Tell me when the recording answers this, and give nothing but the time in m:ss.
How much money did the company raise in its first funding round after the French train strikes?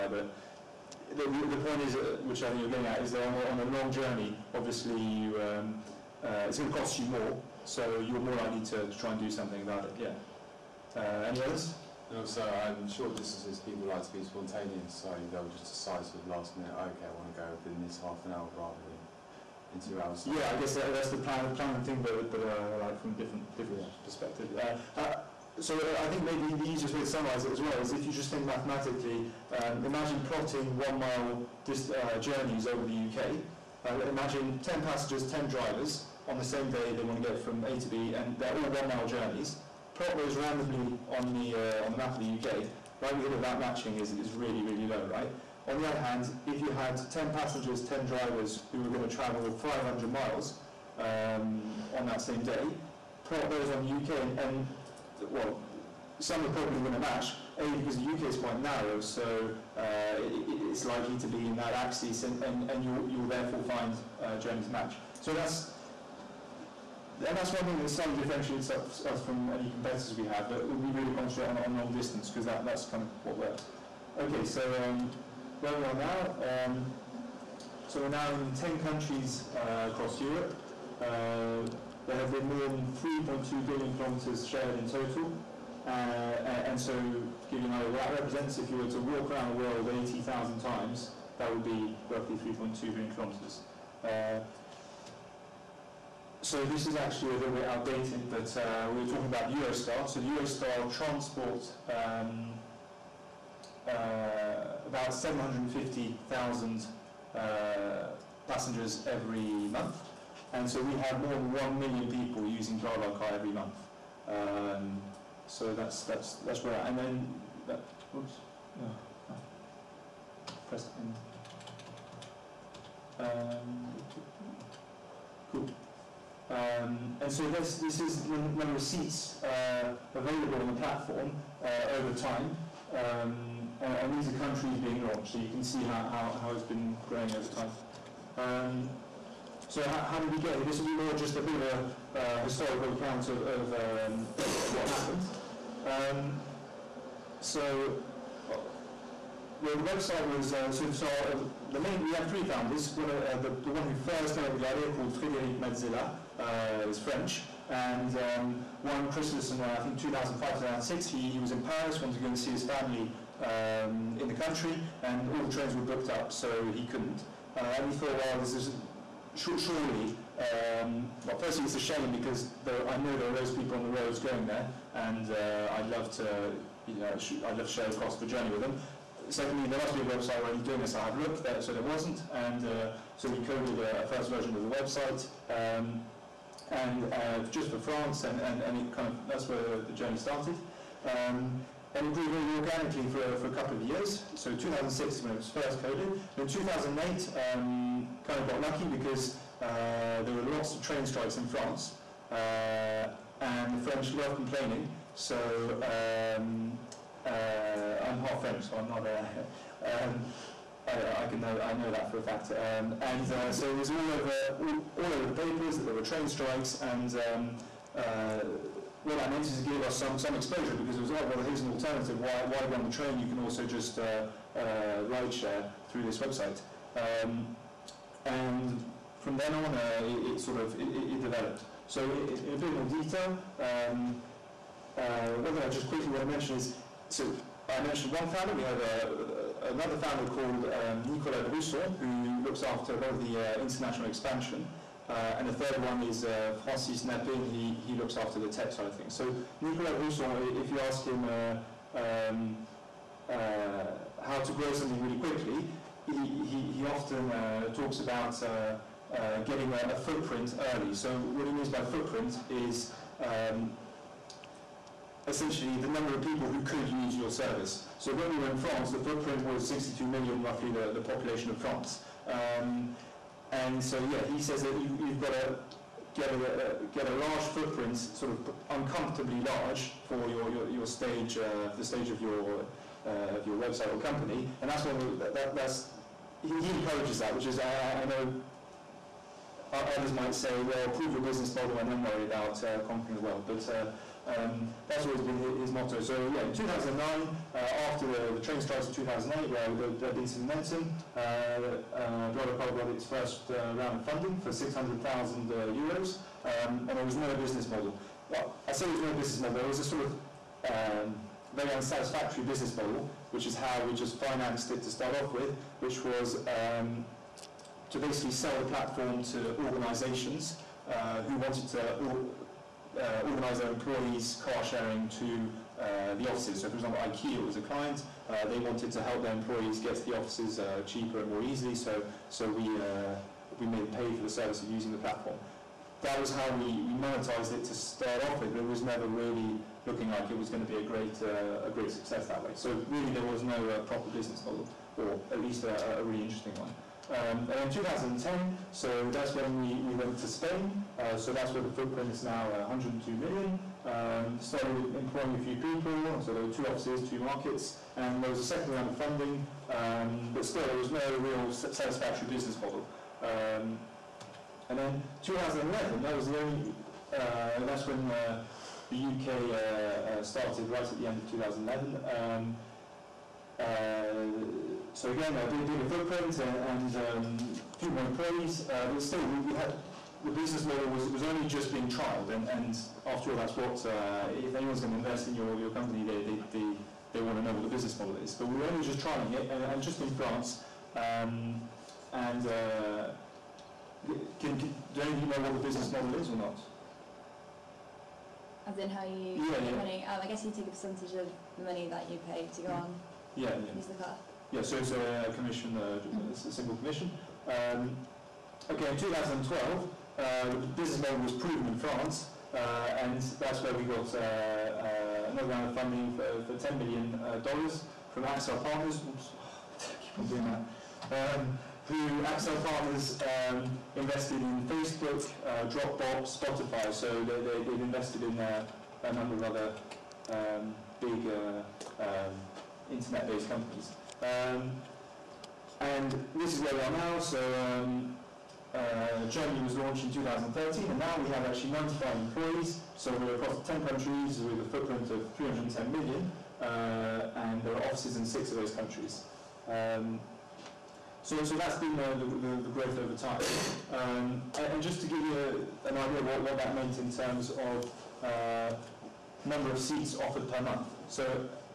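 5:04.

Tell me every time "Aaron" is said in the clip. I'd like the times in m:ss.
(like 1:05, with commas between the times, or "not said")
not said.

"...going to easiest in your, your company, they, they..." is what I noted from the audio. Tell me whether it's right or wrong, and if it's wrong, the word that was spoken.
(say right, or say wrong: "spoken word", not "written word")
wrong: "invest", not "easiest".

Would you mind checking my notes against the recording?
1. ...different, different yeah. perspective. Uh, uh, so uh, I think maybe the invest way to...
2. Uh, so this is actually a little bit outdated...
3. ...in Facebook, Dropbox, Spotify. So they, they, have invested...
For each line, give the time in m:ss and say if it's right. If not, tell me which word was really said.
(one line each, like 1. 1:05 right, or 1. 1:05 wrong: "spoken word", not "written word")
1. 0:23 wrong: "easiest", not "invest"
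2. 1:34 right
3. 7:04 right.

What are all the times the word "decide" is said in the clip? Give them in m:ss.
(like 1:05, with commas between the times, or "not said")
0:15.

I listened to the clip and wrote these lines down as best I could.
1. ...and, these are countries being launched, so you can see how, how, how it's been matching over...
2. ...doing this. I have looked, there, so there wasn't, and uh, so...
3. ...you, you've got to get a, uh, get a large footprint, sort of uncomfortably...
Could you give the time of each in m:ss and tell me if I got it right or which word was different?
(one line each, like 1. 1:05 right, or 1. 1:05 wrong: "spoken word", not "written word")
1. 2:13 wrong: "growing", not "matching"
2. 3:00 right
3. 4:34 right.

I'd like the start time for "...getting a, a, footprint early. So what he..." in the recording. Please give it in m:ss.
4:19.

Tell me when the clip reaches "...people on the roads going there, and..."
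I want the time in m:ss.
2:53.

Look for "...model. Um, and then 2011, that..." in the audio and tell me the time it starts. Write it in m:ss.
6:02.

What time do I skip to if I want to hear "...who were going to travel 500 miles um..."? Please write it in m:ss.
0:48.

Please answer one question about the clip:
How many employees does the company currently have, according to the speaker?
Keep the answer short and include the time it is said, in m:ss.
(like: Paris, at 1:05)
95, at 7:21.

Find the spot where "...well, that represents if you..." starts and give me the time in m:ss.
1:27.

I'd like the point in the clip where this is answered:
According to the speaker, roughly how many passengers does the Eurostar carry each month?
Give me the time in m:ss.
1:45.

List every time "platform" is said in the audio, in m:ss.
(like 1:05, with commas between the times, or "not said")
2:10, 5:18, 5:34.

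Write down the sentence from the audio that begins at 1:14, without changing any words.
Okay, so um, where we are now, um, so we're now in 10 countries uh, across Europe.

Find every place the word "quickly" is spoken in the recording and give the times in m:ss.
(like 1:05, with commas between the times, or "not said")
3:55, 4:15.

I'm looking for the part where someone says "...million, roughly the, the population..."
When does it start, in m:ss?
4:30.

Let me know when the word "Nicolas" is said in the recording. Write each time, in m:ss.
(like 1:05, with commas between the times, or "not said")
4:01, 4:09.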